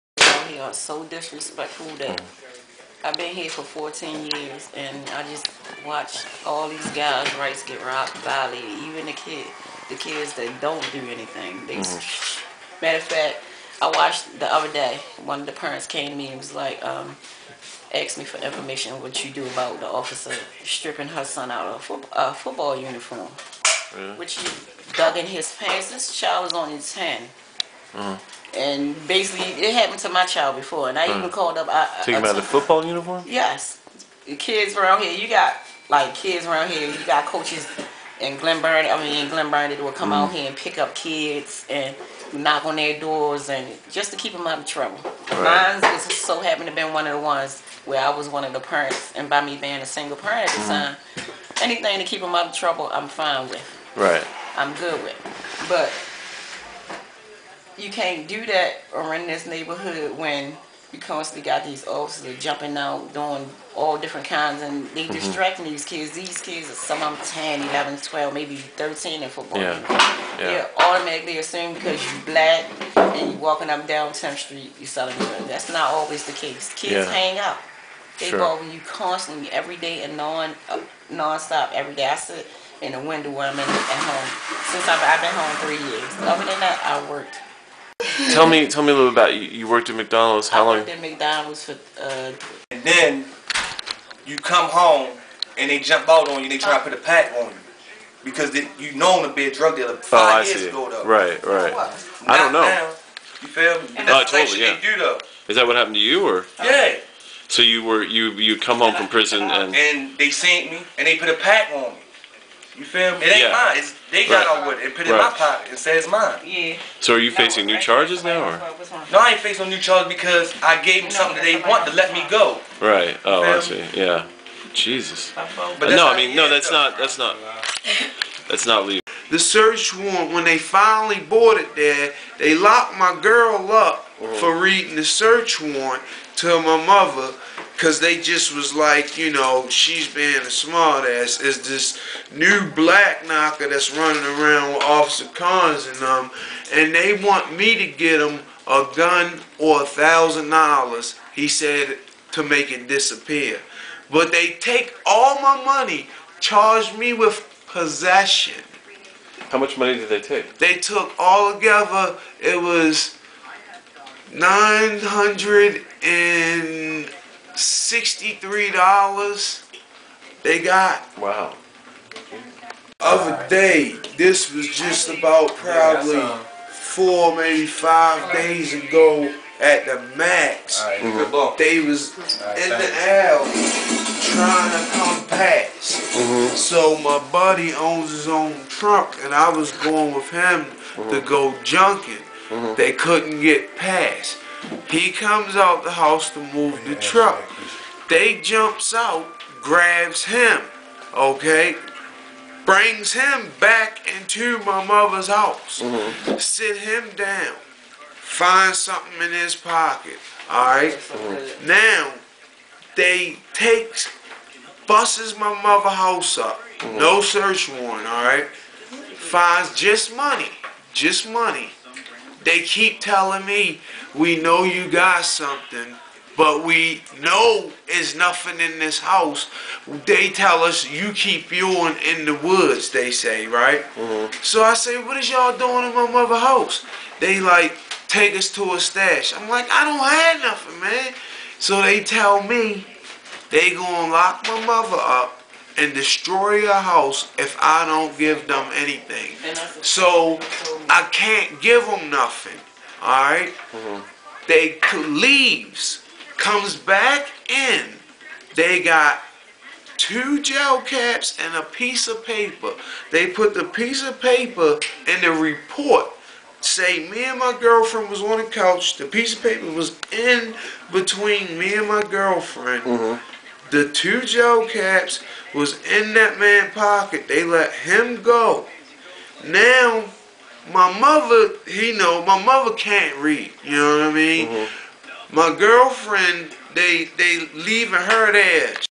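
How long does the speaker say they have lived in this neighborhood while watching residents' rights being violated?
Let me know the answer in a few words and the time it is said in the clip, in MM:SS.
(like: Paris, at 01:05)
14 years, at 00:03.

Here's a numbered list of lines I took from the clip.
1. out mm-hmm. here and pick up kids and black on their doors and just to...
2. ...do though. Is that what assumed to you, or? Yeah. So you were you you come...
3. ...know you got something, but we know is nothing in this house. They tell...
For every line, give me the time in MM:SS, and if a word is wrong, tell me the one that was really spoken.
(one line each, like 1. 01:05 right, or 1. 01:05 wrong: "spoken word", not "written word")
1. 00:40 wrong: "knock", not "black"
2. 01:44 wrong: "happened", not "assumed"
3. 03:44 right.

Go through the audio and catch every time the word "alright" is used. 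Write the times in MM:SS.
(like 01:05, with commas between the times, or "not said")
03:30, 03:38.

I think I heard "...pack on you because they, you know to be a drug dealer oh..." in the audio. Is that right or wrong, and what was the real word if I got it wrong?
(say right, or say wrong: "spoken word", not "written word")
right.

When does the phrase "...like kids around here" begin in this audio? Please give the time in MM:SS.
00:35.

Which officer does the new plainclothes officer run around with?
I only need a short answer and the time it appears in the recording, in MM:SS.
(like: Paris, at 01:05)
Officer Cons, at 02:24.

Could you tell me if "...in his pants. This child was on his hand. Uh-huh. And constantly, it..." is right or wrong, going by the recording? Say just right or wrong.
wrong.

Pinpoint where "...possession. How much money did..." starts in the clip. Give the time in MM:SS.
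02:37.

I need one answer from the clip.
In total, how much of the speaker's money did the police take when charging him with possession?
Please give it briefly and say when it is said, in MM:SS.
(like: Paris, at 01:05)
$963, at 02:44.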